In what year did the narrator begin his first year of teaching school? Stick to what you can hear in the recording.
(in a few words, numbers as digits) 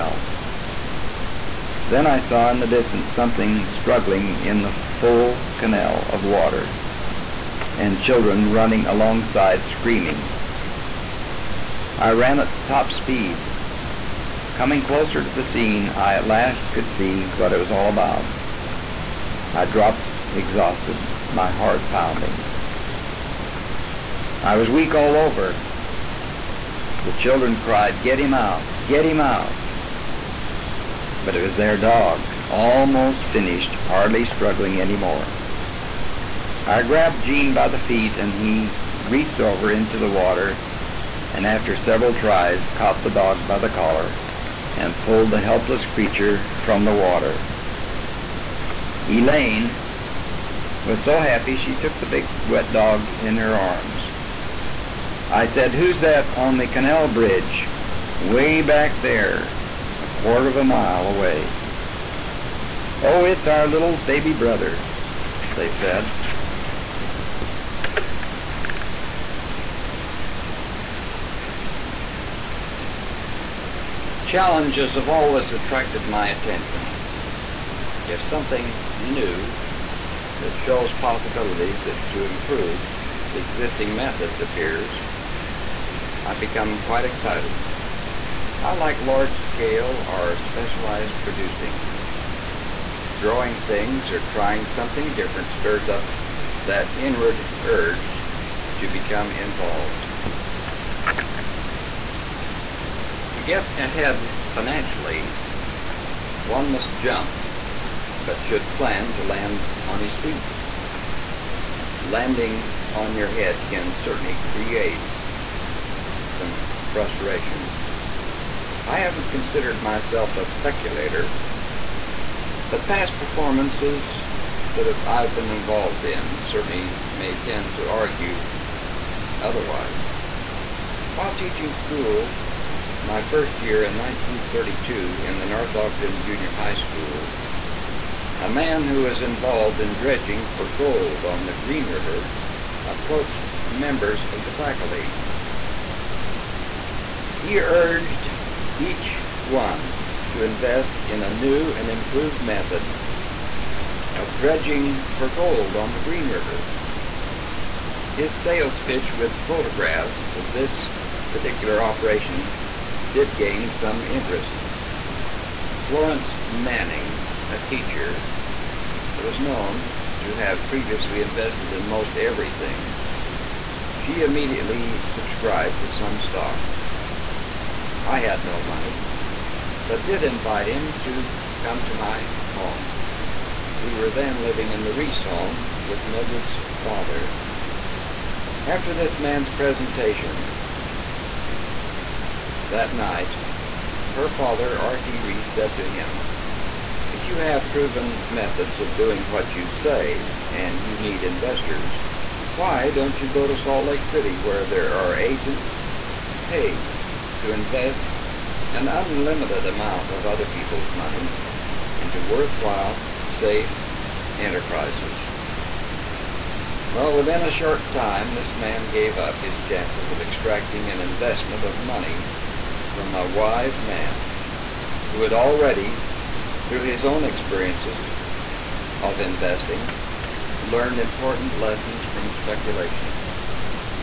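1932.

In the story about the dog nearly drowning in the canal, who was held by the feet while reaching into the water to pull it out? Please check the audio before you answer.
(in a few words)
Jean.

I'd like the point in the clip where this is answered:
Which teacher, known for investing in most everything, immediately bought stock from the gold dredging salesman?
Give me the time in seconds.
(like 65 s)
165 s.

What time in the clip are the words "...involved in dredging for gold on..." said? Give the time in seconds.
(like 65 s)
139 s.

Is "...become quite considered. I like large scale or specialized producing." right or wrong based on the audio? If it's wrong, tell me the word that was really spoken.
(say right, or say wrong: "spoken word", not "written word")
wrong: "excited", not "considered".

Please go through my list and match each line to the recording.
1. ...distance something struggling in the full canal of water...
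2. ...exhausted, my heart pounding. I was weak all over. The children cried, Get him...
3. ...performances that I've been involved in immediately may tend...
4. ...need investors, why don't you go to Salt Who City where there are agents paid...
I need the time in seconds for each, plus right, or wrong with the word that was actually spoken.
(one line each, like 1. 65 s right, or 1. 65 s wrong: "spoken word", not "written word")
1. 2 s right
2. 20 s right
3. 123 s wrong: "certainly", not "immediately"
4. 200 s wrong: "Lake", not "Who".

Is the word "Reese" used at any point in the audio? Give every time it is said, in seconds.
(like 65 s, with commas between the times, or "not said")
184 s, 195 s.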